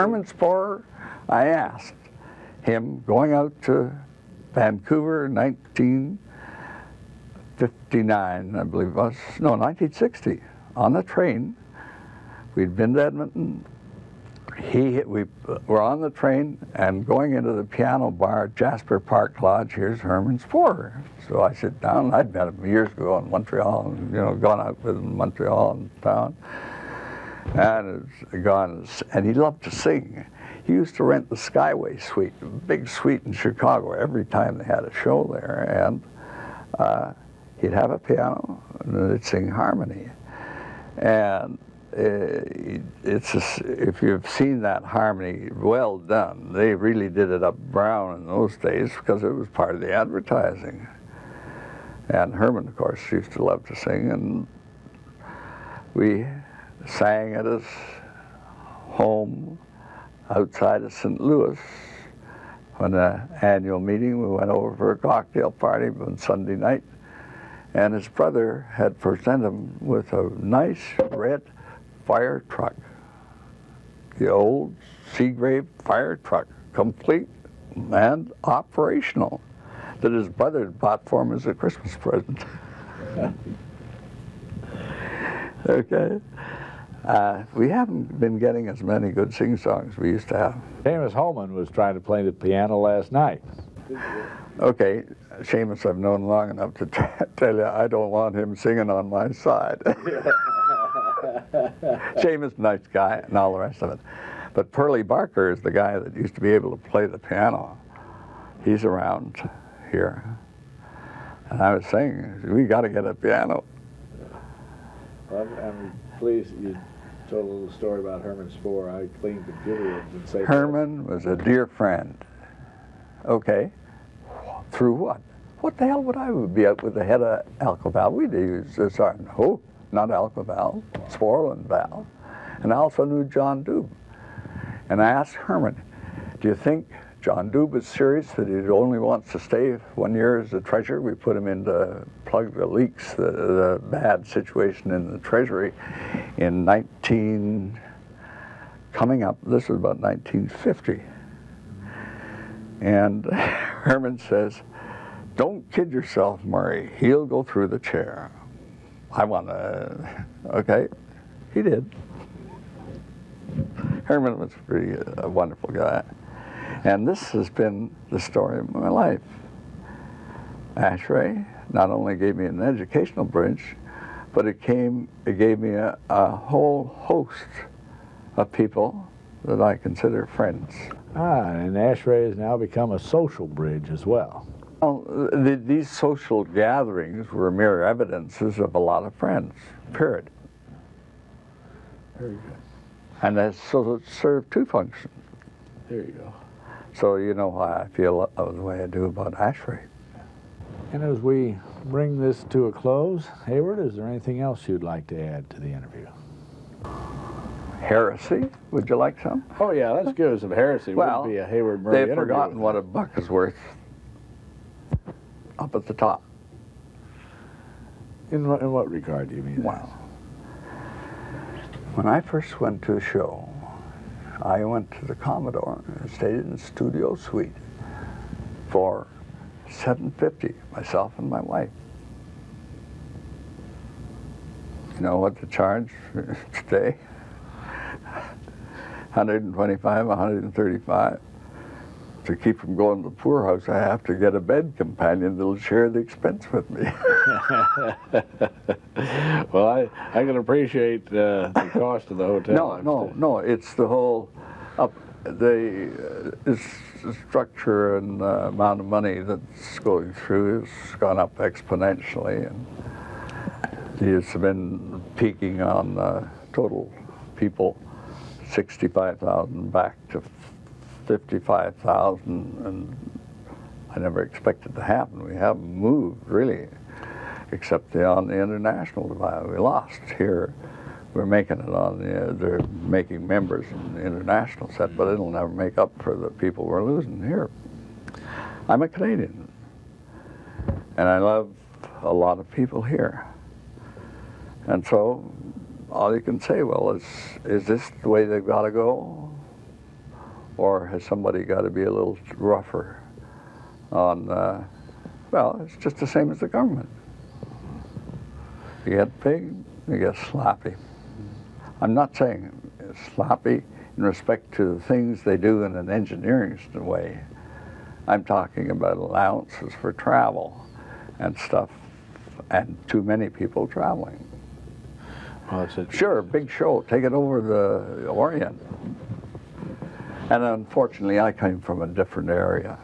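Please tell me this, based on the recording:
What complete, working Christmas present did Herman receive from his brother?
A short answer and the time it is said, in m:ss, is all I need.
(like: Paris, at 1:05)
Seagrave fire truck, at 1:15.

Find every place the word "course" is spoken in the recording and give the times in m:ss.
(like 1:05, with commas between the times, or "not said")
0:52.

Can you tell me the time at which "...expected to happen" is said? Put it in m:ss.
4:34.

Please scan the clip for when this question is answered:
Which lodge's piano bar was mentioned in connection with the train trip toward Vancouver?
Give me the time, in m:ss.
0:18.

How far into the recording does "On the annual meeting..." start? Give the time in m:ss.
1:02.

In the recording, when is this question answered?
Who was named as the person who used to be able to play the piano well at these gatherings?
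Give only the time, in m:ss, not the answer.
1:44.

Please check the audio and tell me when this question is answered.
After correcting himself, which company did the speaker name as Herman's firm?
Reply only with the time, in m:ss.
2:11.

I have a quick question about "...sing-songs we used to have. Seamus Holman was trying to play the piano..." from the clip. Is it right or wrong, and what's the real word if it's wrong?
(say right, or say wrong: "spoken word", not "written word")
right.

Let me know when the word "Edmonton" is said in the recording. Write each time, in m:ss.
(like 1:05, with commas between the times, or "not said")
0:13.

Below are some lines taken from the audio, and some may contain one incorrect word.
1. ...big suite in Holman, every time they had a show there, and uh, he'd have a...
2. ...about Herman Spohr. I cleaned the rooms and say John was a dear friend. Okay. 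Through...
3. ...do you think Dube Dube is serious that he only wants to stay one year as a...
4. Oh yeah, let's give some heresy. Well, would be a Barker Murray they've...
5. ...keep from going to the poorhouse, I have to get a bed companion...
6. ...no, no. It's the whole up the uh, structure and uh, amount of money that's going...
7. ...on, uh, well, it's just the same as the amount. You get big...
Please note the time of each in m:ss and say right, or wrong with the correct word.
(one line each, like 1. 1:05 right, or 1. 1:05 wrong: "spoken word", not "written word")
1. 0:32 wrong: "Chicago", not "Holman"
2. 1:58 wrong: "Herman", not "John"
3. 2:16 wrong: "John", not "Dube"
4. 3:29 wrong: "Hayward", not "Barker"
5. 4:02 right
6. 4:12 right
7. 5:03 wrong: "government", not "amount".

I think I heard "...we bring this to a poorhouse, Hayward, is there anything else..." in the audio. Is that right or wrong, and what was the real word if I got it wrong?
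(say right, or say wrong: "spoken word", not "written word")
wrong: "close", not "poorhouse".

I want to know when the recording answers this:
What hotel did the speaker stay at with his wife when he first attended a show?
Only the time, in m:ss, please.
3:45.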